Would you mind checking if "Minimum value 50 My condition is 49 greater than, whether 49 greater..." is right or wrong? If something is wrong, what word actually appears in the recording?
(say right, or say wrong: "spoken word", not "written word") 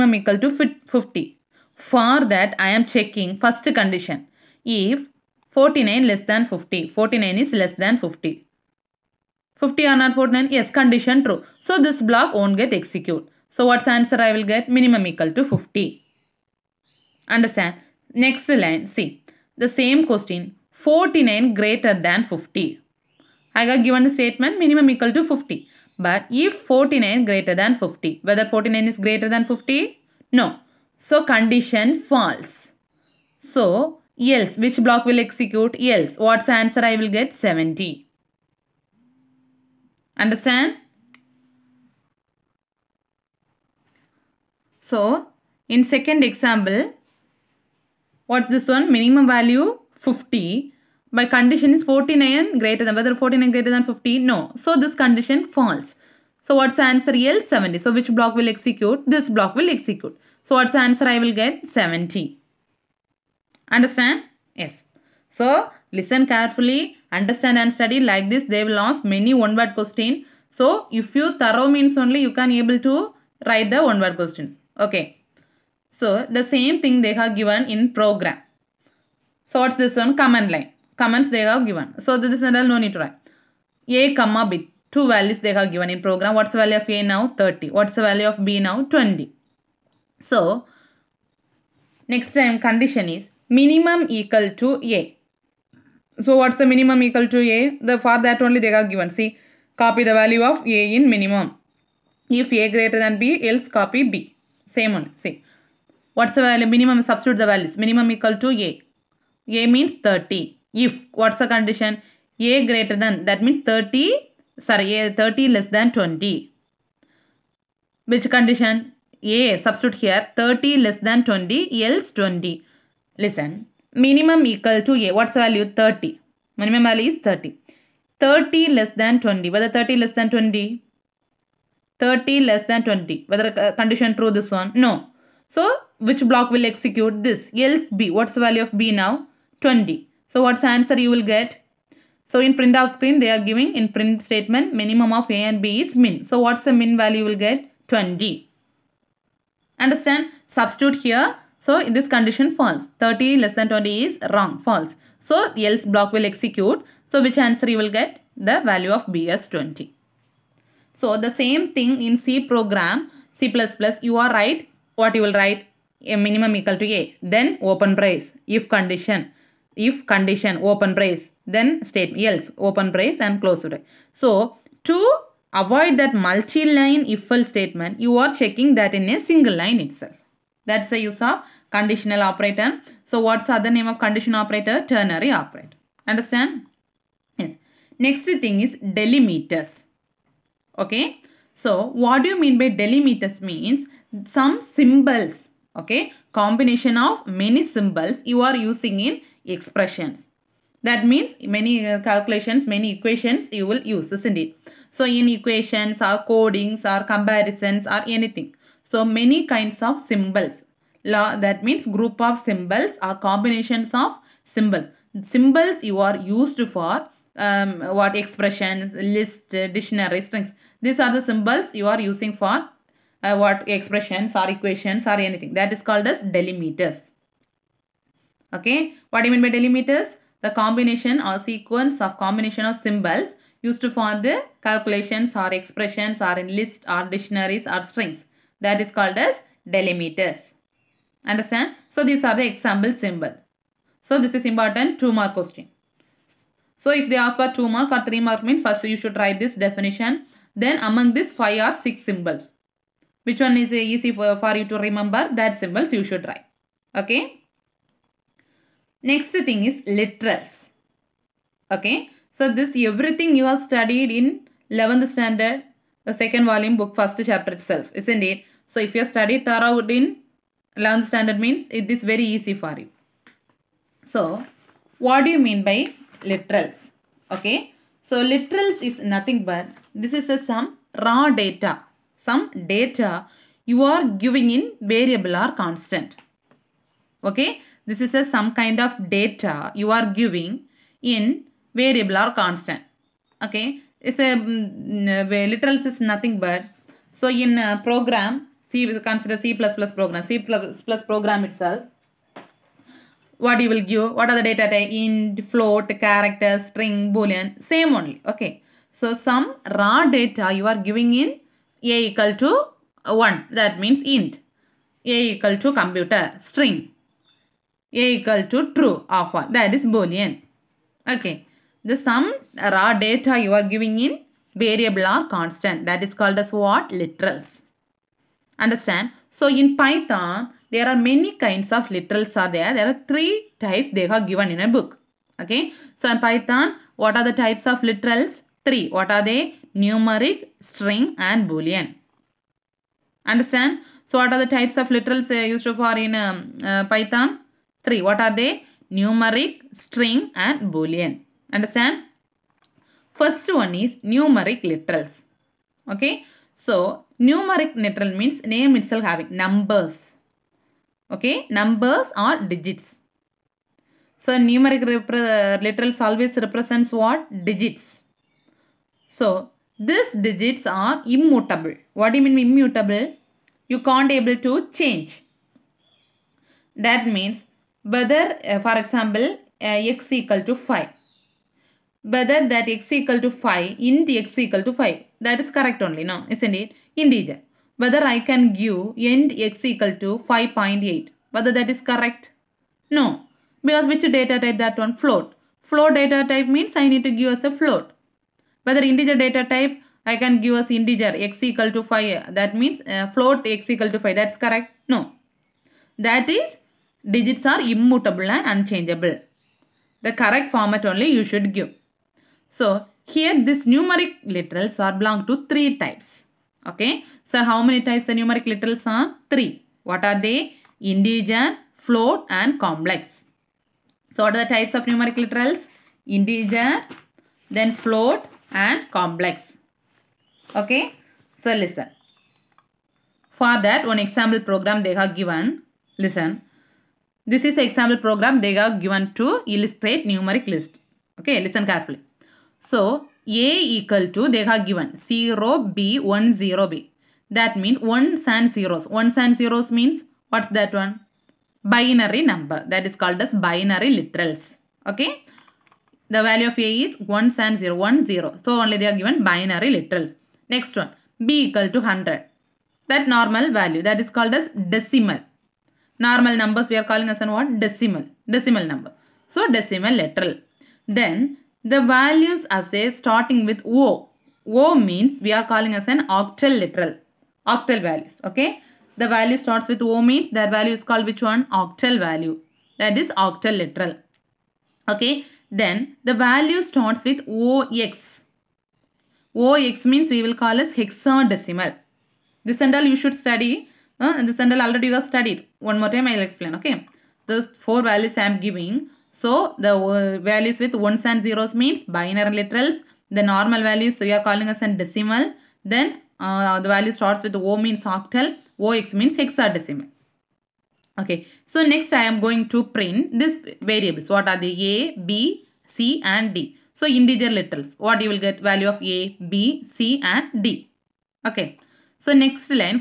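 right.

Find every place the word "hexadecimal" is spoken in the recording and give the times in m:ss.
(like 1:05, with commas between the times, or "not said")
8:10, 8:29.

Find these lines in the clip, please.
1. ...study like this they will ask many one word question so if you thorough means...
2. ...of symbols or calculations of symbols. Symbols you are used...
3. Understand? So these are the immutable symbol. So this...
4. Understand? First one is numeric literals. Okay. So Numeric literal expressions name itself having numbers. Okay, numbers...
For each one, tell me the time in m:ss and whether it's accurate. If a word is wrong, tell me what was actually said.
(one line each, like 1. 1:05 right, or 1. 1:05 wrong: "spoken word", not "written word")
1. 1:07 right
2. 3:32 wrong: "combinations", not "calculations"
3. 4:01 wrong: "example", not "immutable"
4. 5:51 wrong: "means", not "expressions".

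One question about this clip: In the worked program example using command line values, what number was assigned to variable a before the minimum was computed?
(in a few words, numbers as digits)
30.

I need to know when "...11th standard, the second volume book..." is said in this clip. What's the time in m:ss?
4:24.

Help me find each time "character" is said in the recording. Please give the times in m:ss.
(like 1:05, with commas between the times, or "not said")
5:05.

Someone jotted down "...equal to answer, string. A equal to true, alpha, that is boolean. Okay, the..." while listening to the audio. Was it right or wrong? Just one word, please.
wrong.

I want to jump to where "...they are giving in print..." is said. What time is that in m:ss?
2:23.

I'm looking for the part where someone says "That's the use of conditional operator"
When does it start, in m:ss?
3:00.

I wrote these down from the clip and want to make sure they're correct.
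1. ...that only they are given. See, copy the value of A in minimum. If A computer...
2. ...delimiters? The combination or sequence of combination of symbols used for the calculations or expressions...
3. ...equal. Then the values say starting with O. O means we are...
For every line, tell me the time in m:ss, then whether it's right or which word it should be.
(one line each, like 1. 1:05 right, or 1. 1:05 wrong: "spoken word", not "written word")
1. 1:38 wrong: "greater", not "computer"
2. 3:49 right
3. 7:49 wrong: "literal", not "equal".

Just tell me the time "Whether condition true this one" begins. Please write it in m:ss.
2:13.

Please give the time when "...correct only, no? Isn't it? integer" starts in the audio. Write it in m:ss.
6:25.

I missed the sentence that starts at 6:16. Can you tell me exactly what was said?
That means whether, uh, for example, uh, x equal to 5.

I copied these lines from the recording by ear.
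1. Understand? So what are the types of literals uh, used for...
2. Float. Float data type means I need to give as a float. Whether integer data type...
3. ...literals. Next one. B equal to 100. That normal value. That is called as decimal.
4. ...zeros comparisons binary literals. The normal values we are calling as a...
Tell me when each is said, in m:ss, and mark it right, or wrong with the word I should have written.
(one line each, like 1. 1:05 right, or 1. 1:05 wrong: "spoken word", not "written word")
1. 5:43 right
2. 6:34 right
3. 7:39 right
4. 8:21 wrong: "means", not "comparisons".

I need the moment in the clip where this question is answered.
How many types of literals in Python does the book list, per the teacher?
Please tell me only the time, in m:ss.
5:32.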